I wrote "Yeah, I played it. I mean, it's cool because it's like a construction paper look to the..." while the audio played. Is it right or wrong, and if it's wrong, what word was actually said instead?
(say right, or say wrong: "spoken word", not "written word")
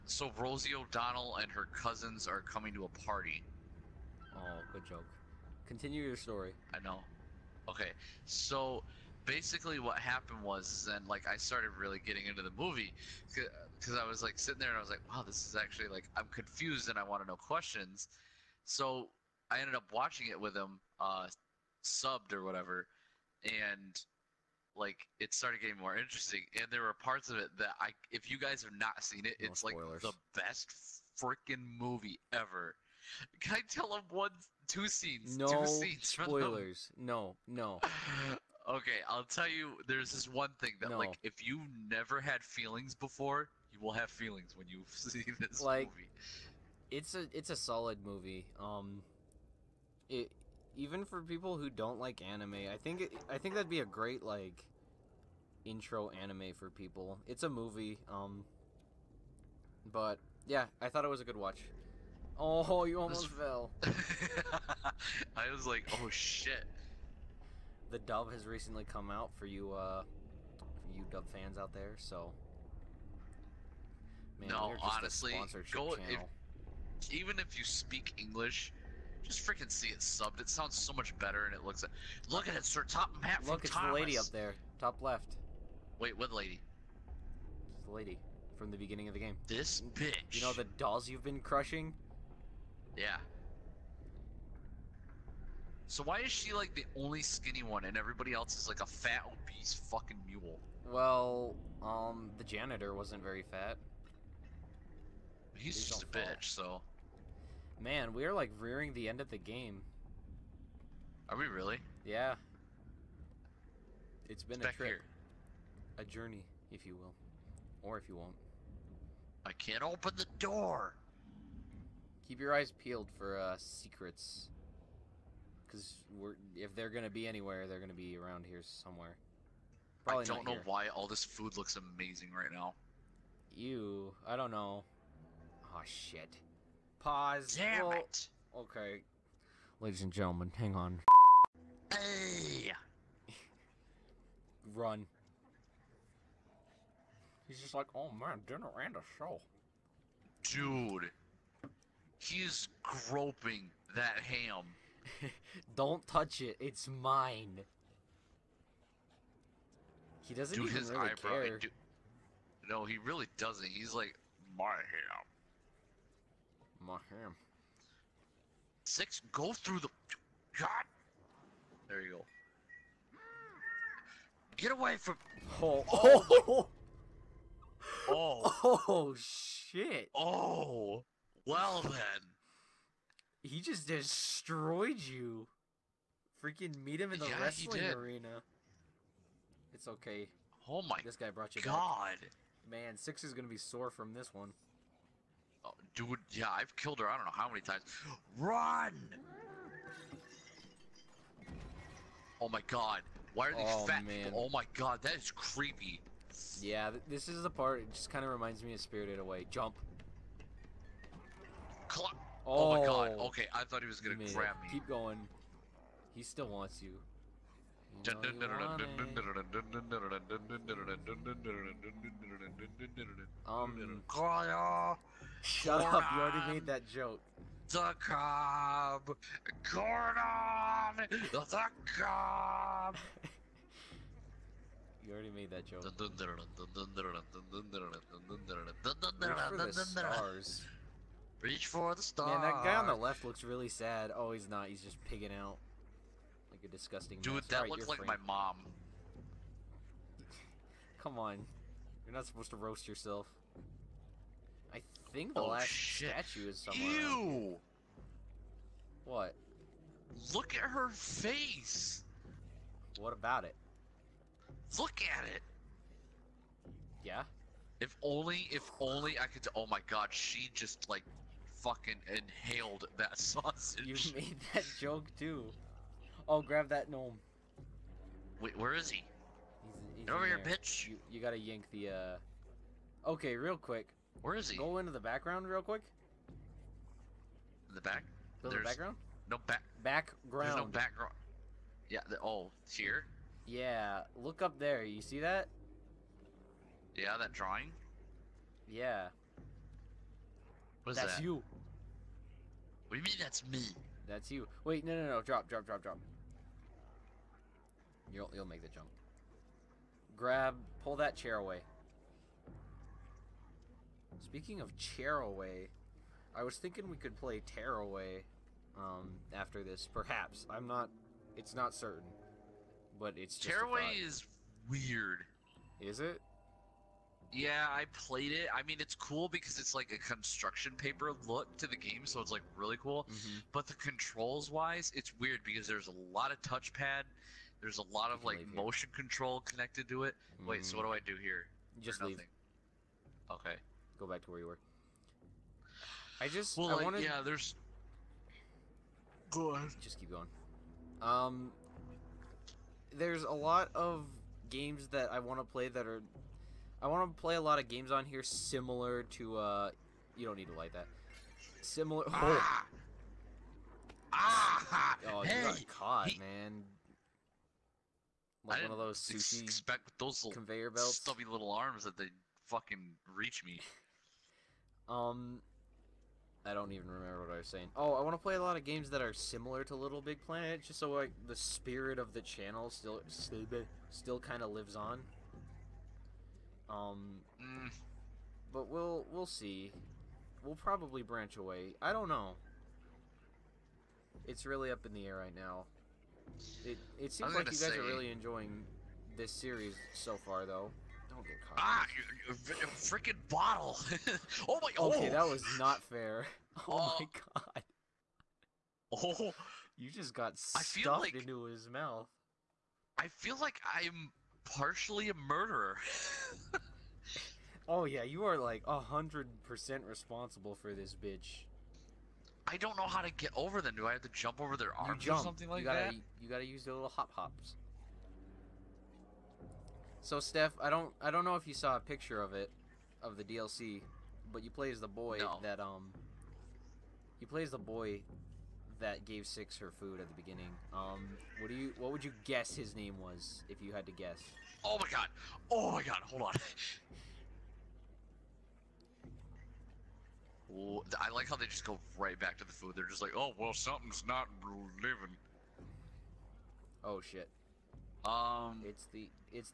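right.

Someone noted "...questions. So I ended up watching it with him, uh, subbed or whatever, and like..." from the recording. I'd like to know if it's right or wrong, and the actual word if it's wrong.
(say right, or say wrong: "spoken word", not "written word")
right.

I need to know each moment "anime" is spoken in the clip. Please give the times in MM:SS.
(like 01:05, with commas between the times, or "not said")
00:52, 00:56.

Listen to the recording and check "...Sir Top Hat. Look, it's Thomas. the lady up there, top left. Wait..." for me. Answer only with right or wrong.
right.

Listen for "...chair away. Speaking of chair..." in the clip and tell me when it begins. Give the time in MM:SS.
05:11.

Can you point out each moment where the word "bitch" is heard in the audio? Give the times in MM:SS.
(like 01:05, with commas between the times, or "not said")
01:29, 01:46, 04:40, 07:00.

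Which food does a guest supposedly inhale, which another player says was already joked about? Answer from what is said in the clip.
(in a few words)
sausage.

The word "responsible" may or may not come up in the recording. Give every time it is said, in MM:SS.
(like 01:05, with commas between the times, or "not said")
06:59.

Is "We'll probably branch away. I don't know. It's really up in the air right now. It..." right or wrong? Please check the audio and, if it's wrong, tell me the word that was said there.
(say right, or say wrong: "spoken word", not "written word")
right.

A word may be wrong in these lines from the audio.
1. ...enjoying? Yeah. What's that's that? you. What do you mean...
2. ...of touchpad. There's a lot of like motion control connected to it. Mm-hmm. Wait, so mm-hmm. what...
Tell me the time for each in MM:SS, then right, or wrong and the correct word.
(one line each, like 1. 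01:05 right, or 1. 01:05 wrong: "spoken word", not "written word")
1. 04:57 wrong: "drawing", not "enjoying"
2. 05:36 right.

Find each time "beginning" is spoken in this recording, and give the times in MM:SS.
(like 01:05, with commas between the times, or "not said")
01:28, 07:20.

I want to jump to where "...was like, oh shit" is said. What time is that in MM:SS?
01:05.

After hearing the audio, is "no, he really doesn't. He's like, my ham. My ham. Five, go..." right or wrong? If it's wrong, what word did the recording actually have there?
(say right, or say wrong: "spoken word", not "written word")
wrong: "Six", not "Five".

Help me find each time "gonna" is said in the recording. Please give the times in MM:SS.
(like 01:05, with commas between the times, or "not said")
03:13, 03:33.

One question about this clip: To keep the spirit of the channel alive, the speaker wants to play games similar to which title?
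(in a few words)
Little Big Planet.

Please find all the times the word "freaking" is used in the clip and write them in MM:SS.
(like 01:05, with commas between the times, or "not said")
00:31, 01:19, 03:06, 06:42.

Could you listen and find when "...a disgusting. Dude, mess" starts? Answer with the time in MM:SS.
04:06.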